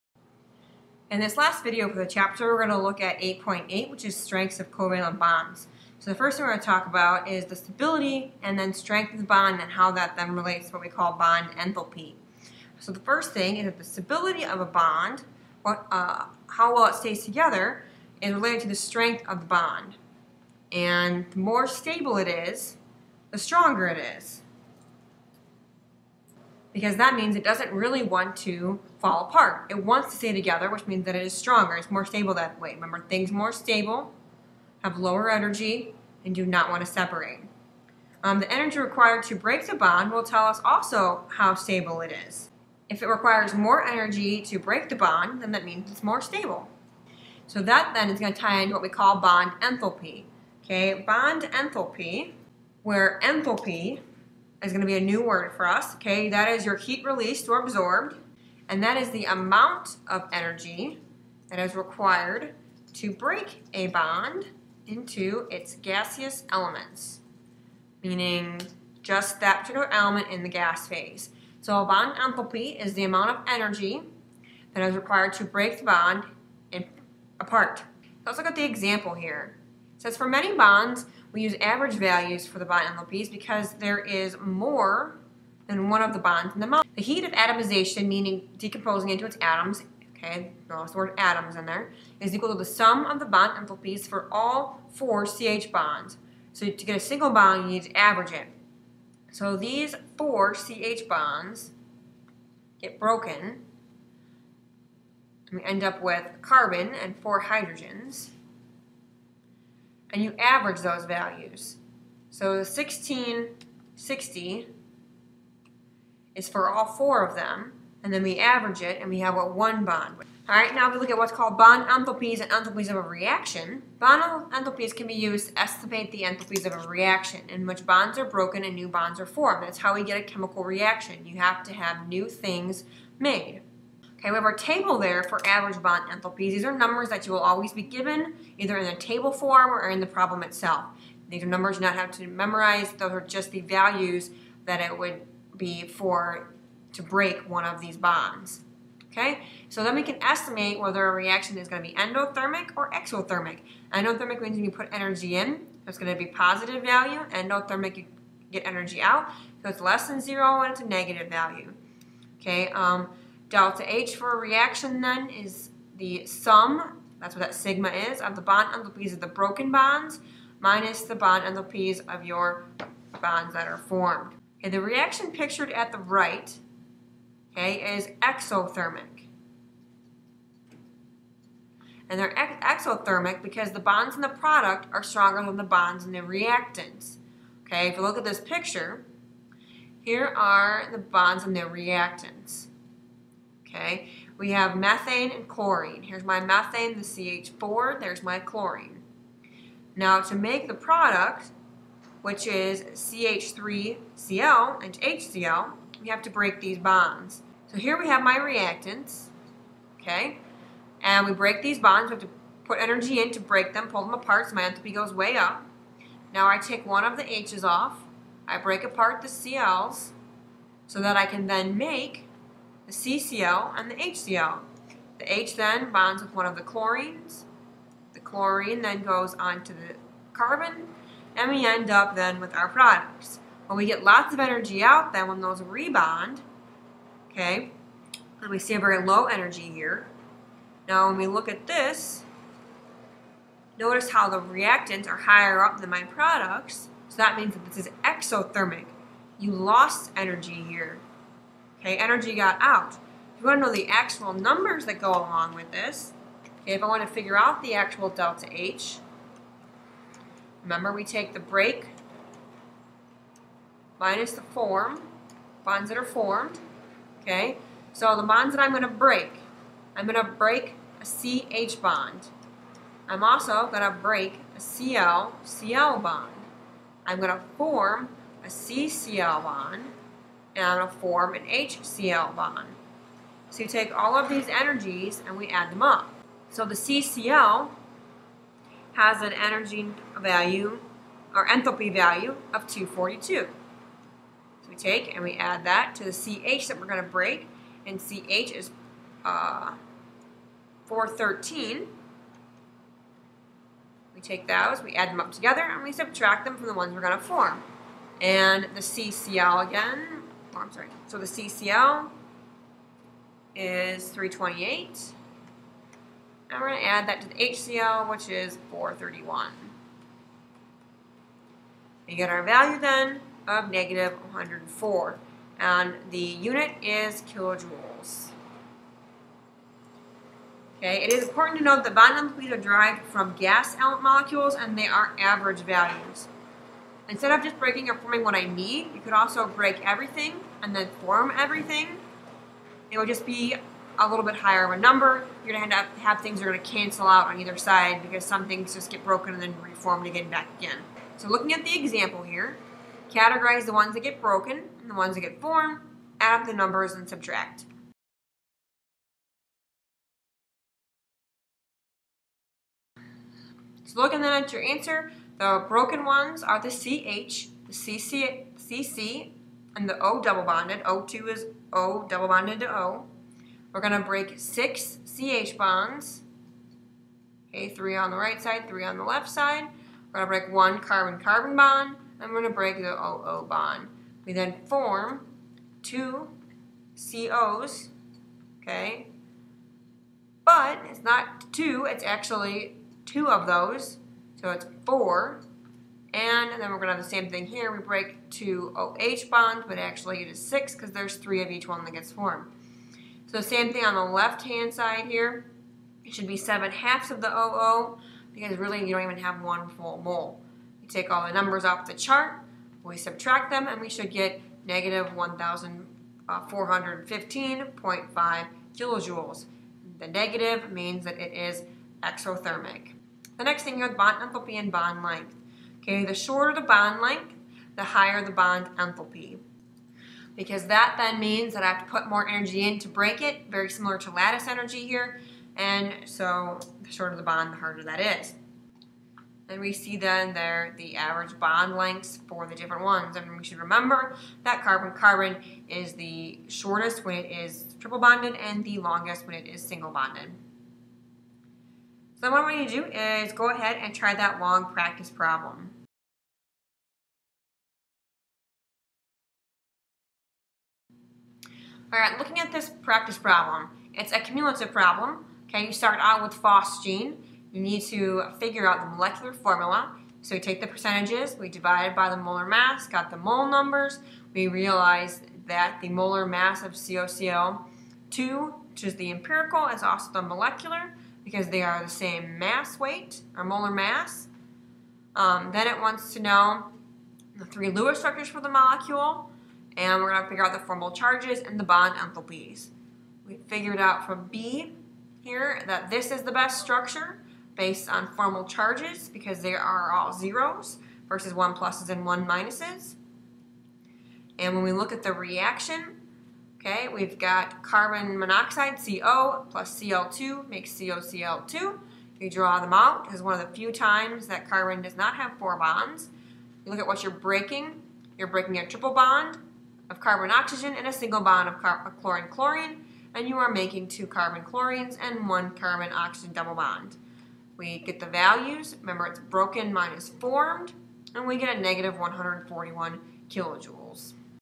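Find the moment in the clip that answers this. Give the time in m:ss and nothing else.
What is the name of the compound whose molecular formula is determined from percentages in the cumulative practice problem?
7:46.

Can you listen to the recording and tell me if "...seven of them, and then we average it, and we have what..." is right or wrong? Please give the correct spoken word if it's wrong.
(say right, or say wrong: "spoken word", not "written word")
wrong: "four", not "seven".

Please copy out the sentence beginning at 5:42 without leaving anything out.
It would just be a little bit higher of a number.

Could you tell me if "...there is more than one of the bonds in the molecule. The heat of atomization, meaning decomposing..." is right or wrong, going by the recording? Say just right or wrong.
right.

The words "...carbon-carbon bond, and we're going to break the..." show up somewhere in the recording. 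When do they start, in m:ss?
6:20.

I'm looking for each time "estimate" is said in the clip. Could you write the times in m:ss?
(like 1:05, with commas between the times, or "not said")
2:05, 2:30.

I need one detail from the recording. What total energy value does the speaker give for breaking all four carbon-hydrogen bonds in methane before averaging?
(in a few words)
1660.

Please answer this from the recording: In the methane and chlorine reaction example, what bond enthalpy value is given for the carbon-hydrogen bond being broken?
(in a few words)
413.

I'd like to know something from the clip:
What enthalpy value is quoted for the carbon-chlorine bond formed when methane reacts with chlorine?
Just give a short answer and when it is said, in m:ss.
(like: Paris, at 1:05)
328, at 5:14.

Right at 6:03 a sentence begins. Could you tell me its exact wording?
So looking then at your answer, the broken ones are the CH, the CC, CC, and the O double bonded.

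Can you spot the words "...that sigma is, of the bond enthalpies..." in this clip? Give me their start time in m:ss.
2:47.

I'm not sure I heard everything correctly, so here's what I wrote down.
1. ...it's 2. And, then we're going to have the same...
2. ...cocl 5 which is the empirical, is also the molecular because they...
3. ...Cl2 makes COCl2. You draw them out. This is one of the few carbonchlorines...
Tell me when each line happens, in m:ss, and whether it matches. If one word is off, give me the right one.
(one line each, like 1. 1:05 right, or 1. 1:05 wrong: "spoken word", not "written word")
1. 6:34 wrong: "4", not "2"
2. 7:56 wrong: "2", not "5"
3. 8:29 wrong: "times", not "carbonchlorines".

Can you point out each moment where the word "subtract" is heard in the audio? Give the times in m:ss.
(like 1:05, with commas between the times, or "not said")
5:05, 5:57, 6:52.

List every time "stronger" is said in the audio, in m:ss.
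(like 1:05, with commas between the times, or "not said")
0:23, 0:31, 3:05.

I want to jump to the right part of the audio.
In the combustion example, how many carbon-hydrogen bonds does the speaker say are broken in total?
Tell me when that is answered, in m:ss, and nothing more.
6:14.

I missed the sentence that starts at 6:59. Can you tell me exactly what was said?
The negative means that it is exothermic.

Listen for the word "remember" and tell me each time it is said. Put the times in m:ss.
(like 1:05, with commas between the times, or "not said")
0:32, 4:20, 7:23, 8:48.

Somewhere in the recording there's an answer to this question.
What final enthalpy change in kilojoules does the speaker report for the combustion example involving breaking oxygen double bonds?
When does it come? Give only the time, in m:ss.
6:54.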